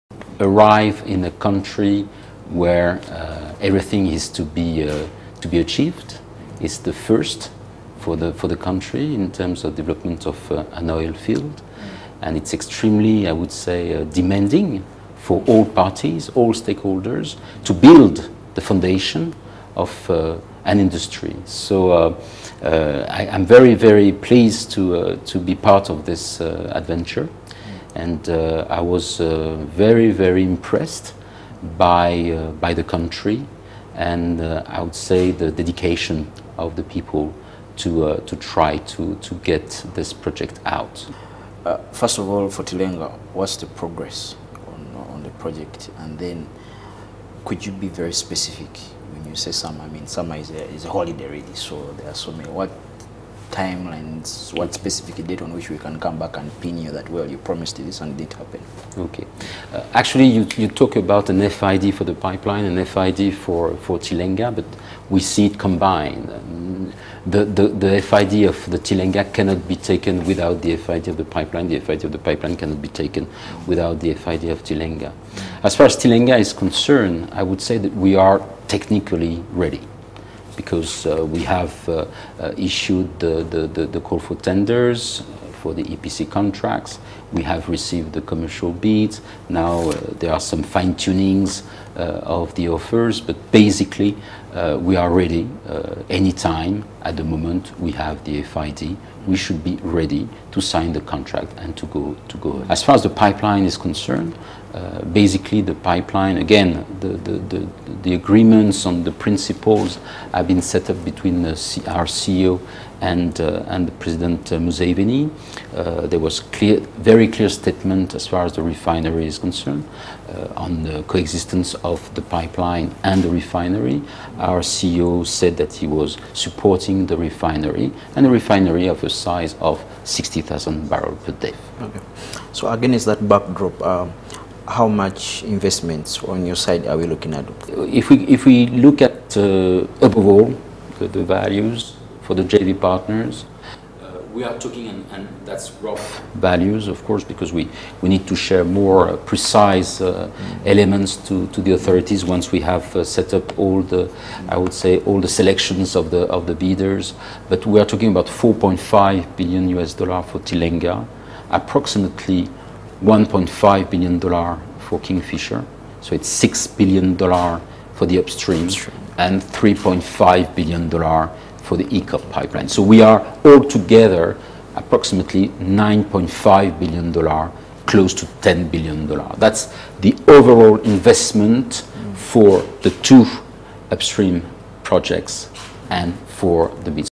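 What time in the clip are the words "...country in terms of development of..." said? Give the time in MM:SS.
00:08.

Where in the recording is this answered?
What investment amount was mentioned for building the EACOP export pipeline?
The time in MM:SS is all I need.
02:49.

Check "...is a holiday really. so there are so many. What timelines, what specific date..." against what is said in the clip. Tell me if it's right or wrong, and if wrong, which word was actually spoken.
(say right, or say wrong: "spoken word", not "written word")
right.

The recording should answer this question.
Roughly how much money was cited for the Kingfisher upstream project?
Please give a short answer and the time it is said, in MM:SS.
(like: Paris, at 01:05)
$1.5 billion, at 02:43.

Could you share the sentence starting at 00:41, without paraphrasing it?
Uh, first of all, for Tilenga, what's the progress on, on the project?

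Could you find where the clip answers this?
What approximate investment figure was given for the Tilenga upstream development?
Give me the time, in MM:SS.
02:38.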